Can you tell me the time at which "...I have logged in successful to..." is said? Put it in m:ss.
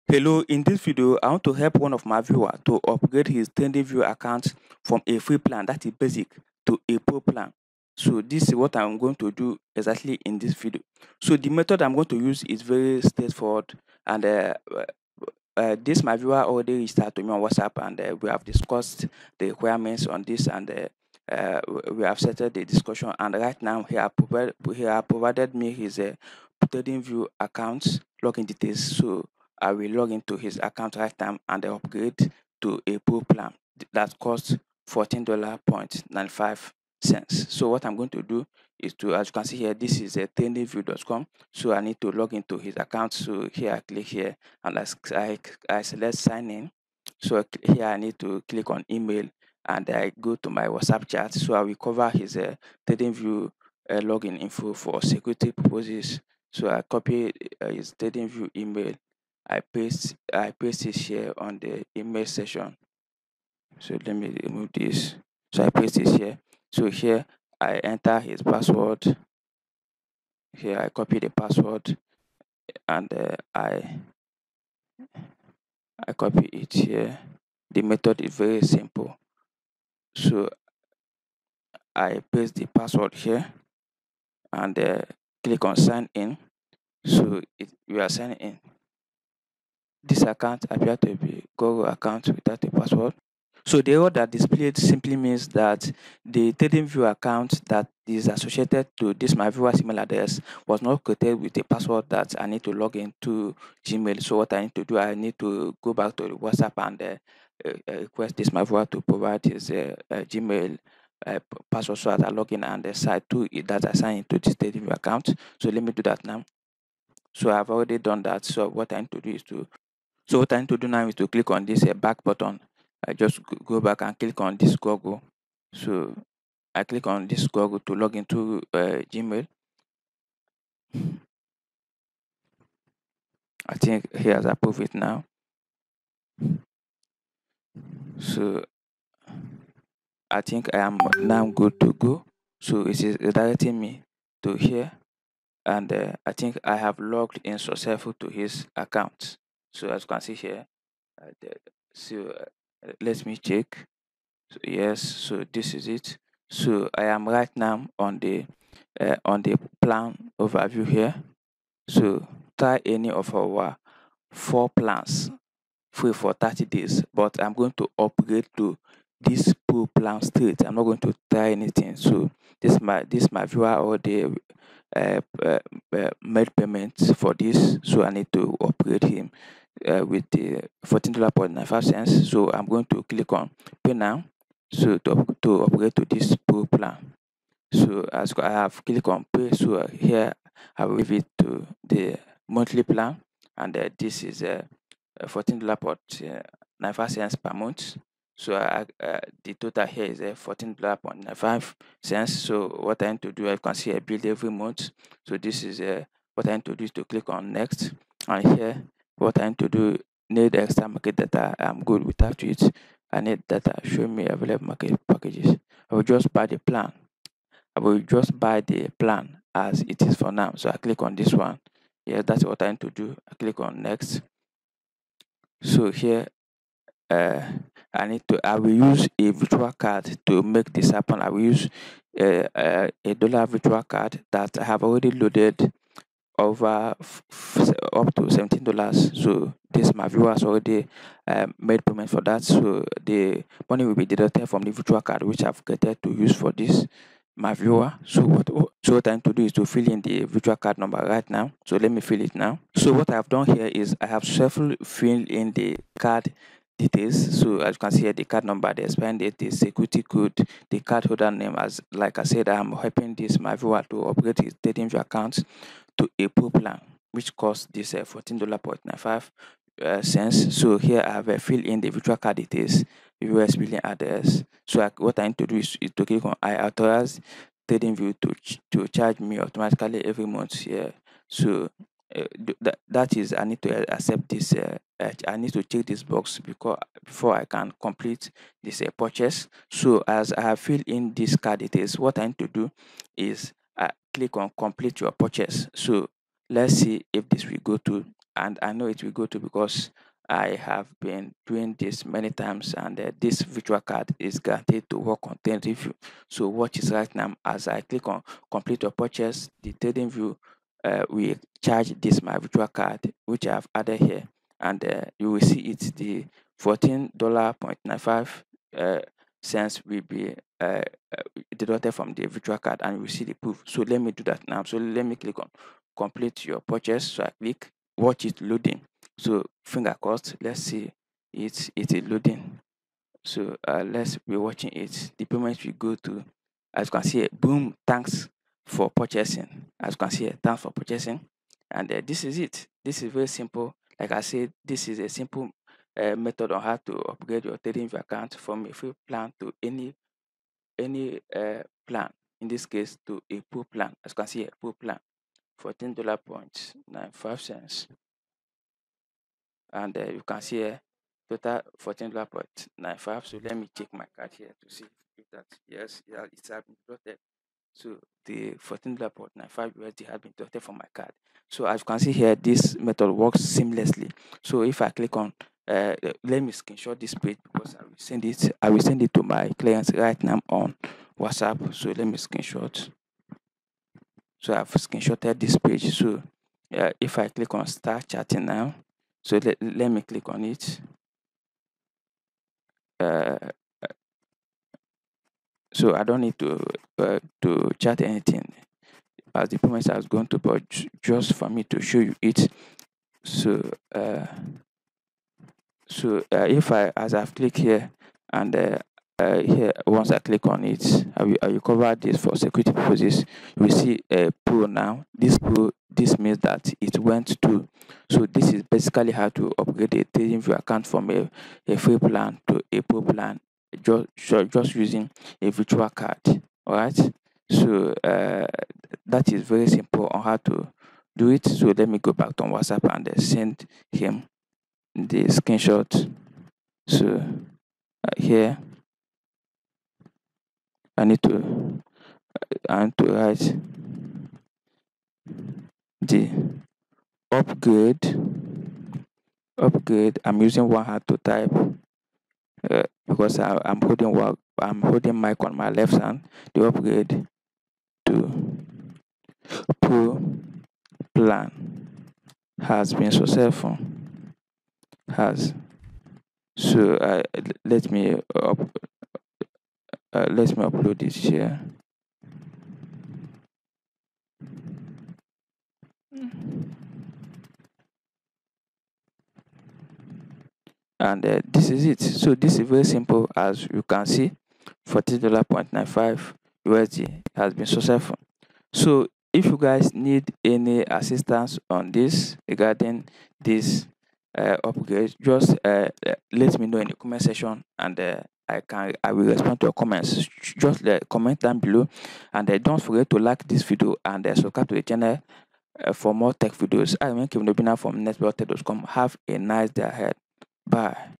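2:26.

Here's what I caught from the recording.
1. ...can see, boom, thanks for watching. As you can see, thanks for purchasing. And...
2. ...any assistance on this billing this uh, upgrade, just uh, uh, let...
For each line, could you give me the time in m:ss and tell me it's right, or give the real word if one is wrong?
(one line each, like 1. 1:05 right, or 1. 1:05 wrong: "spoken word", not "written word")
1. 5:36 wrong: "purchasing", not "watching"
2. 8:10 wrong: "regarding", not "billing".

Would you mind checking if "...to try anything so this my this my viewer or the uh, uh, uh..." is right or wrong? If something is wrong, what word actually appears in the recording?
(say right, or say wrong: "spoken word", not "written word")
right.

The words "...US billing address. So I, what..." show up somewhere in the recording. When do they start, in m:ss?
4:33.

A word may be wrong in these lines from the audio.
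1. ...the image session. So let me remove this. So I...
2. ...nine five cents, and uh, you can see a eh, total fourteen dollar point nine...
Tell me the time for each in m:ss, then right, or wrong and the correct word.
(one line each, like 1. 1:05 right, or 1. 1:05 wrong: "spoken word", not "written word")
1. 1:01 right
2. 5:56 right.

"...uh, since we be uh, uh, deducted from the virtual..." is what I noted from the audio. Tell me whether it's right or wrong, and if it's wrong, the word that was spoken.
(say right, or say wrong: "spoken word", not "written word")
right.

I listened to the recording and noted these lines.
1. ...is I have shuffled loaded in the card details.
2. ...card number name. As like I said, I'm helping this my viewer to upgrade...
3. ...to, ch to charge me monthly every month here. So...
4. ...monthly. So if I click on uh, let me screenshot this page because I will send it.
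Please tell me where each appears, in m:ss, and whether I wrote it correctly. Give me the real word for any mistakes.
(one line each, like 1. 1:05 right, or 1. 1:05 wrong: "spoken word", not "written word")
1. 4:13 wrong: "filled", not "loaded"
2. 4:20 wrong: "holder", not "number"
3. 4:38 wrong: "automatically", not "monthly"
4. 6:13 wrong: "seamlessly", not "monthly".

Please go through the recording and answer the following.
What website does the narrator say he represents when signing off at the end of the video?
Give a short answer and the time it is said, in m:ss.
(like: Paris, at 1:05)
netblogtech.com, at 8:28.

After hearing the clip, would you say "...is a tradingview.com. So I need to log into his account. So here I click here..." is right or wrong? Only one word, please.
right.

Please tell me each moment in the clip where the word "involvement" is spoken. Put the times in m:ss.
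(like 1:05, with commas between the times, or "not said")
not said.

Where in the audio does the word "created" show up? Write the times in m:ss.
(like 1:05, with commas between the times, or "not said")
1:41, 4:05.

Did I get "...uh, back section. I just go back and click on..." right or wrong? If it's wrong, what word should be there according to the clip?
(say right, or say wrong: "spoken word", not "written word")
wrong: "button", not "section".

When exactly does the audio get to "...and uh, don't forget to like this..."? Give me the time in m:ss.
8:22.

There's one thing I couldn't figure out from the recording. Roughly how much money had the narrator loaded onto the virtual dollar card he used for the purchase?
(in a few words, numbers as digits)
$17.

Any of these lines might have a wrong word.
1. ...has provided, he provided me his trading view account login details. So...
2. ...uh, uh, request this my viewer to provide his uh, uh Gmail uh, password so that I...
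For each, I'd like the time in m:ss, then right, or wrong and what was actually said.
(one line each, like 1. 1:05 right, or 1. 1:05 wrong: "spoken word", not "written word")
1. 0:23 right
2. 1:47 right.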